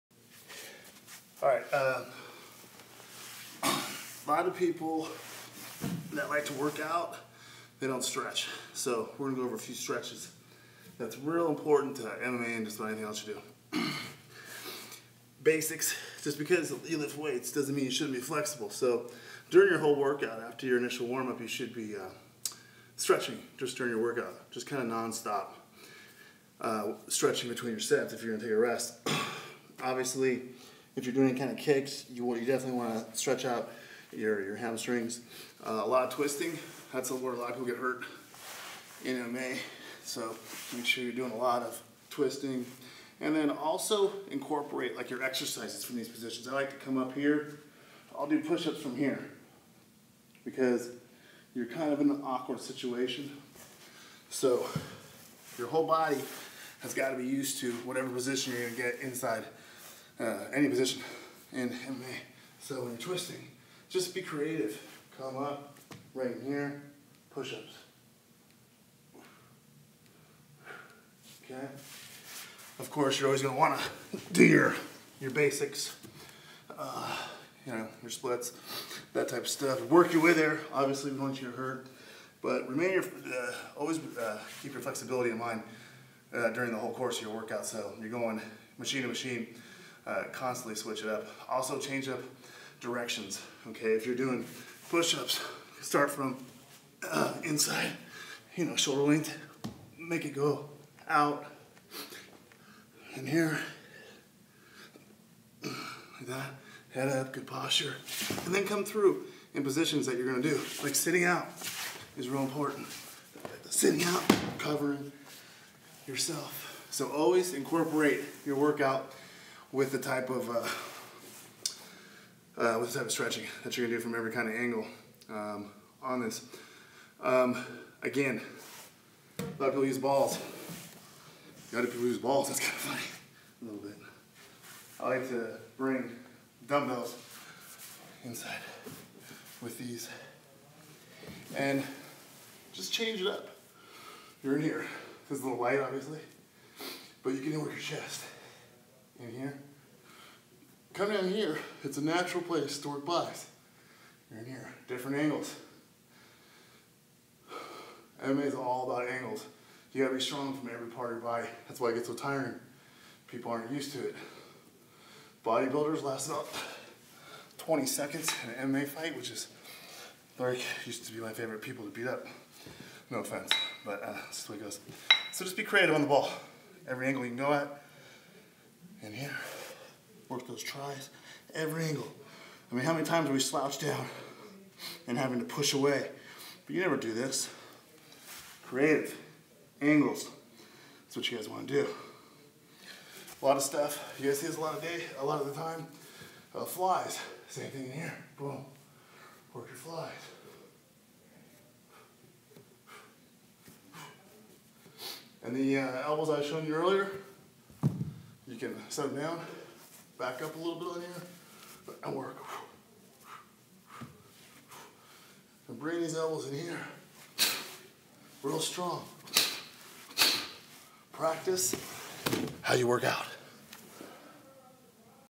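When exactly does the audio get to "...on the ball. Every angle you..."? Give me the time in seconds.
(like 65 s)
175 s.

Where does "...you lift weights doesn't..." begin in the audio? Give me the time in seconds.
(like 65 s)
16 s.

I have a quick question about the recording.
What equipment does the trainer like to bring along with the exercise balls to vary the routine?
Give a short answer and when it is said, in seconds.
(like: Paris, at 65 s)
dumbbells, at 136 s.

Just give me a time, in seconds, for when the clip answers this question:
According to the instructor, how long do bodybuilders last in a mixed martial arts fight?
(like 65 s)
167 s.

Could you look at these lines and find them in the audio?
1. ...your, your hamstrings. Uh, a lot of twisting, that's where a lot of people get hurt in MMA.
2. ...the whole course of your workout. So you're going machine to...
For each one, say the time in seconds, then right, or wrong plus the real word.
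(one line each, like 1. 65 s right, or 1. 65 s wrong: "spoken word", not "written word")
1. 34 s right
2. 86 s right.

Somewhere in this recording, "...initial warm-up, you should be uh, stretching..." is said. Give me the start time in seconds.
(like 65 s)
20 s.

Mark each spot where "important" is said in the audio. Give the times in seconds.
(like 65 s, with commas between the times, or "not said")
11 s, 112 s.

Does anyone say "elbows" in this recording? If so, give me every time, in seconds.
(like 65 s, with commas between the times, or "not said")
206 s, 216 s.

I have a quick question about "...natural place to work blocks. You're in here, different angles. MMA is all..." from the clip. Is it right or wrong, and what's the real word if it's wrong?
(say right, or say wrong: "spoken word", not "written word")
right.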